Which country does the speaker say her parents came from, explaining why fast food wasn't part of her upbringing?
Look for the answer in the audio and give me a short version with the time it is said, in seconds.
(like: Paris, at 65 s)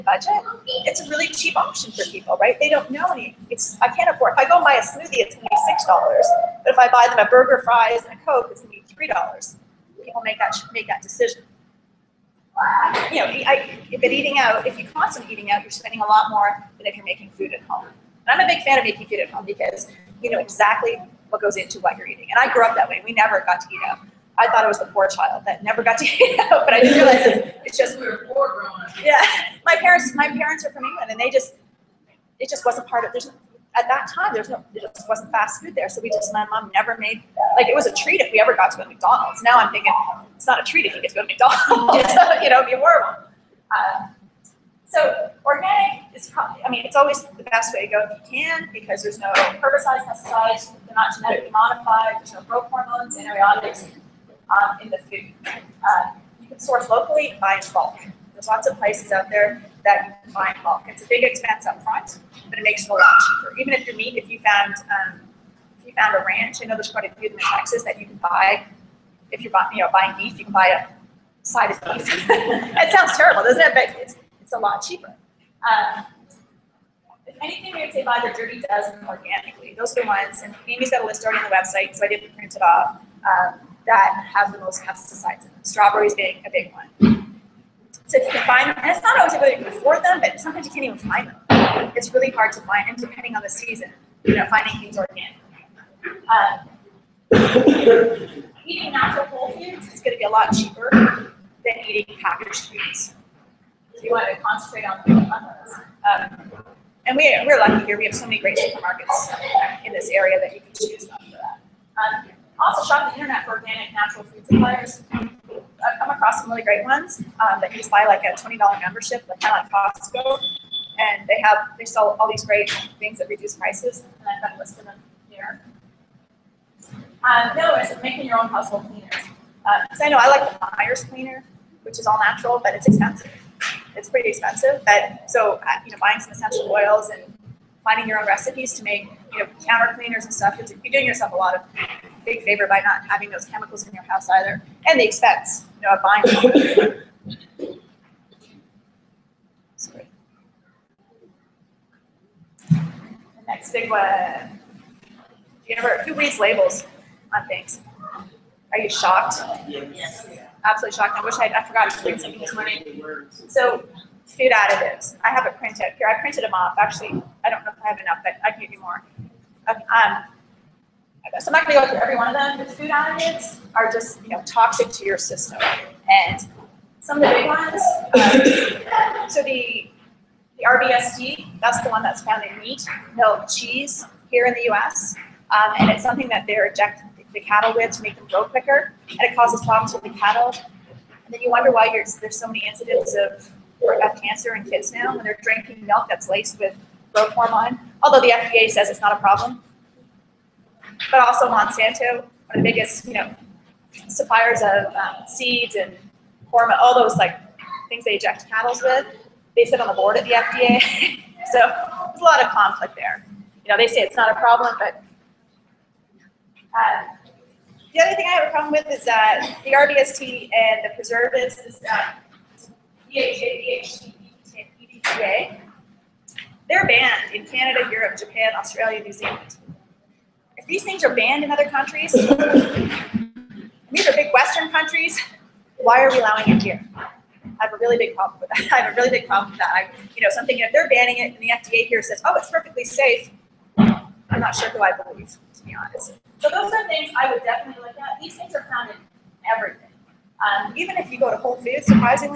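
England, at 30 s.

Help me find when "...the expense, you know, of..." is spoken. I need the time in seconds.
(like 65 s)
144 s.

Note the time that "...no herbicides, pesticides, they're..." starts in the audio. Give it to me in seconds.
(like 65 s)
49 s.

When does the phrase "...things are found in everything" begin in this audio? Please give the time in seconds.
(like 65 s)
248 s.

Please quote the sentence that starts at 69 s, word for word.
If you're buying, you know, buying beef, you can buy a side of beef.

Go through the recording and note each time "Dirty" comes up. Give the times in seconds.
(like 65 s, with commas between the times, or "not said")
78 s.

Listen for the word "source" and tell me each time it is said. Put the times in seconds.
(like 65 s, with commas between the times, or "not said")
56 s.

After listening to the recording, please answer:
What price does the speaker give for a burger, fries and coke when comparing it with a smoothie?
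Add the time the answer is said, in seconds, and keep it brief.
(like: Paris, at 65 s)
$3, at 8 s.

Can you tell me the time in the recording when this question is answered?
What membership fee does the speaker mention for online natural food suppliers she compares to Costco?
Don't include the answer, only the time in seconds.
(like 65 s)
118 s.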